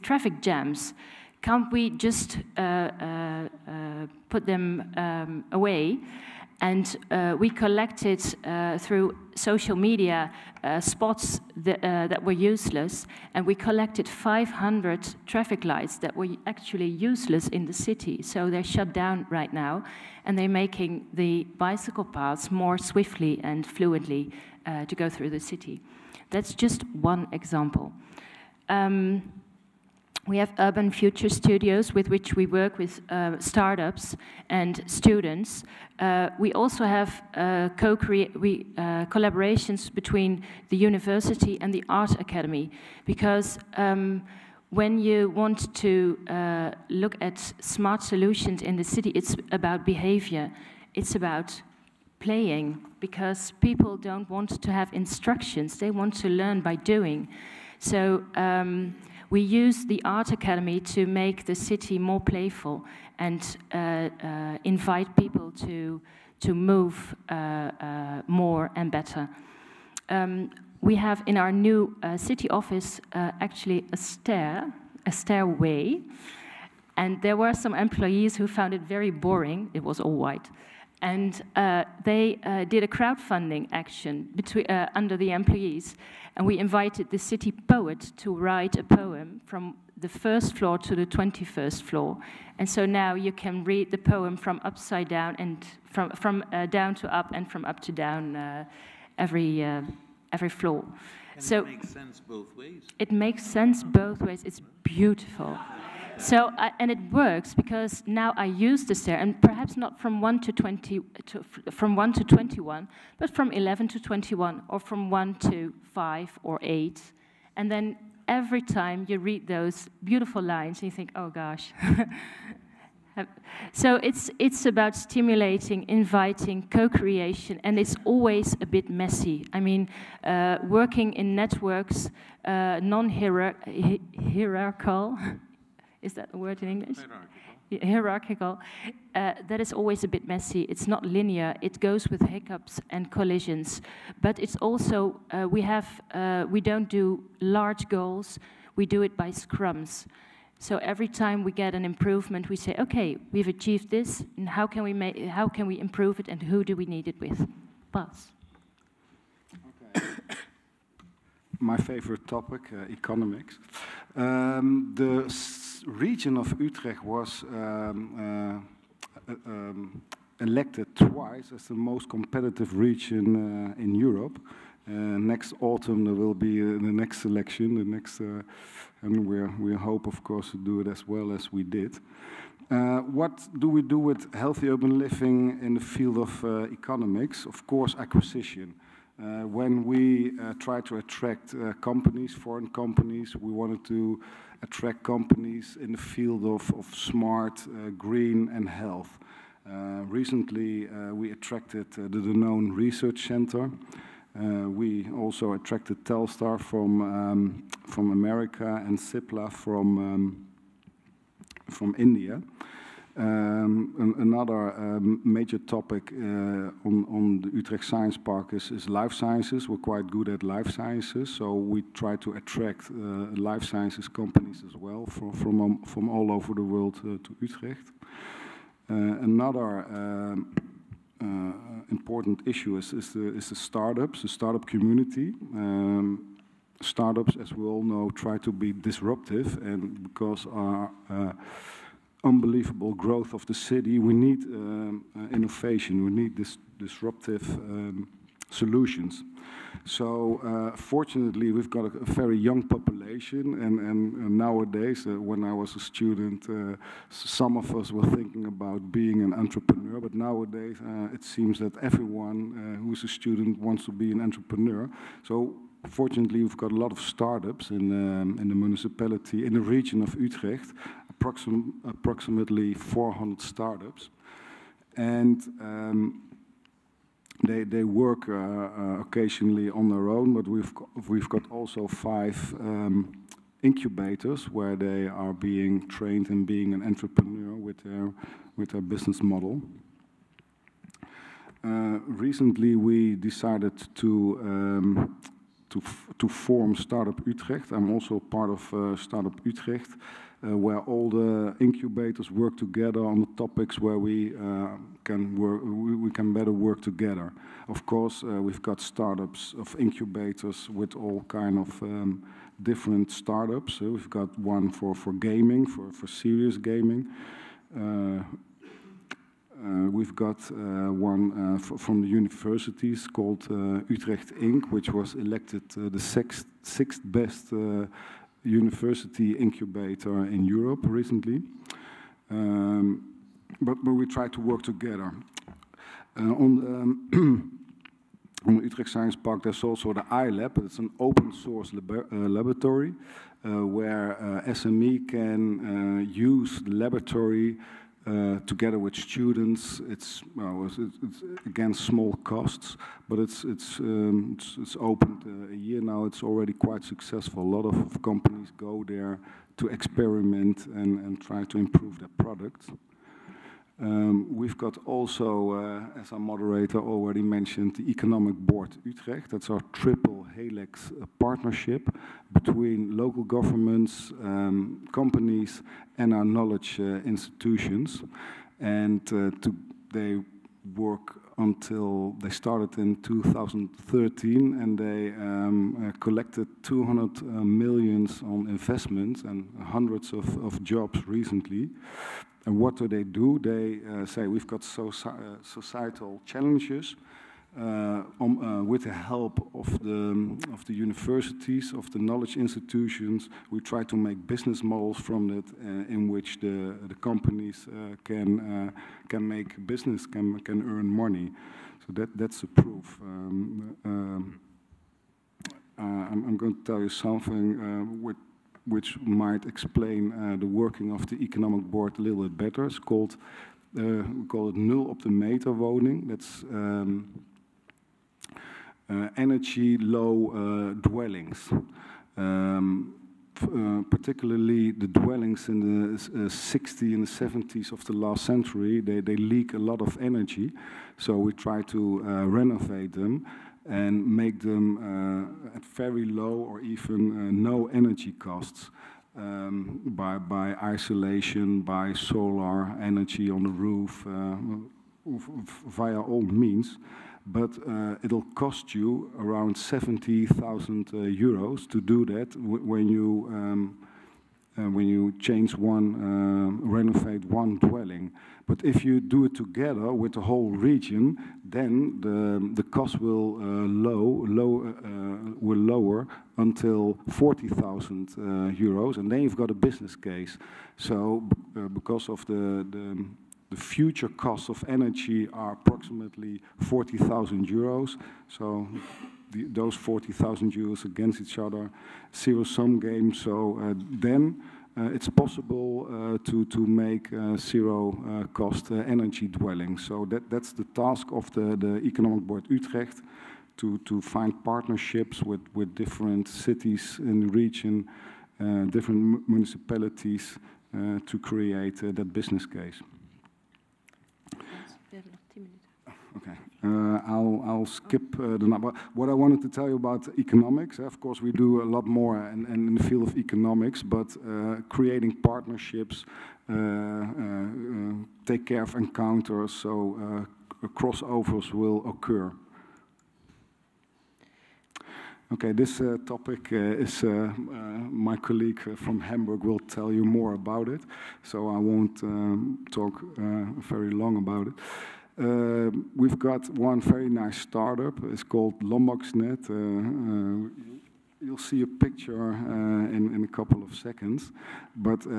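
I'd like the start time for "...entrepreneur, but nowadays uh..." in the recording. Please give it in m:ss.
4:19.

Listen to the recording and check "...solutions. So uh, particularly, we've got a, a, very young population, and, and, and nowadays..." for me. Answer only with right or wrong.
wrong.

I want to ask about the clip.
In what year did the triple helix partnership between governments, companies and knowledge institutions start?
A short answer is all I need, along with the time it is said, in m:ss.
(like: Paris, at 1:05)
2013, at 6:22.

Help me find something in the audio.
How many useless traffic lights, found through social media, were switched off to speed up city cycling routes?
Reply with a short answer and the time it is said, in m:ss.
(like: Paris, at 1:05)
500, at 0:14.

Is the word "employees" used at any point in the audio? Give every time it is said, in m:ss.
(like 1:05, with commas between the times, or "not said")
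1:17, 1:25.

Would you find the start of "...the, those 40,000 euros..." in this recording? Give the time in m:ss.
8:09.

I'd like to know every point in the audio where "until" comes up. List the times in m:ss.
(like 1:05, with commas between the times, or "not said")
6:21, 7:56.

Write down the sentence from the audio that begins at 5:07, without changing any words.
Of course, uh, we've got startups of incubators with all kind of um, different startups.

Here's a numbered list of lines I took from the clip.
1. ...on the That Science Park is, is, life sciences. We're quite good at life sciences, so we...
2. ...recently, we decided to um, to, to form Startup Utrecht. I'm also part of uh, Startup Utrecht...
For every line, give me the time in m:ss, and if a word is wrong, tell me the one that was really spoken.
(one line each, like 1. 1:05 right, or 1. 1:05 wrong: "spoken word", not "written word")
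1. 3:37 wrong: "Utrecht", not "That"
2. 4:52 right.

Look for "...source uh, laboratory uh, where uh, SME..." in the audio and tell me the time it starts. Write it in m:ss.
5:41.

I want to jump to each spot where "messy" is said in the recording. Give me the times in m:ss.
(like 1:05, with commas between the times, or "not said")
2:08, 2:20.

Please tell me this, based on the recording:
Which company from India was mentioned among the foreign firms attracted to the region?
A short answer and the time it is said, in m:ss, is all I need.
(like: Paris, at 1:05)
Cipla, at 3:28.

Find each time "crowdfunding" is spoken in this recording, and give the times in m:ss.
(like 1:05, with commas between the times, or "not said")
1:22.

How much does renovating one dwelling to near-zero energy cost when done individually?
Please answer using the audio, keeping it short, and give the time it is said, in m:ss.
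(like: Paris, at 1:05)
70,000 euros, at 7:39.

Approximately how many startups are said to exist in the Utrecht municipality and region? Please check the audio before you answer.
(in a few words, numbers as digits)
400.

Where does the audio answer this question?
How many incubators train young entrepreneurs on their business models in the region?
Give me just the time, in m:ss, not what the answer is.
4:41.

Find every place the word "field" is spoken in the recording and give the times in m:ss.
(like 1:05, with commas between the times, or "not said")
3:05, 3:15, 8:42.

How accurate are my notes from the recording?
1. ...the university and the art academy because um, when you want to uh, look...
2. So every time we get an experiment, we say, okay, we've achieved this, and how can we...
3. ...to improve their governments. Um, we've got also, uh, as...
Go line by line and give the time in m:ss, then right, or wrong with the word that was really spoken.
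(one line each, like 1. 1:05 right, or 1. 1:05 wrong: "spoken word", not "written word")
1. 0:40 right
2. 2:30 wrong: "improvement", not "experiment"
3. 6:01 wrong: "products", not "governments".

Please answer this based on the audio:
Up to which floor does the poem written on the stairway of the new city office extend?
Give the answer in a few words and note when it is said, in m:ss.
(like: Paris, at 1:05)
21st floor, at 1:30.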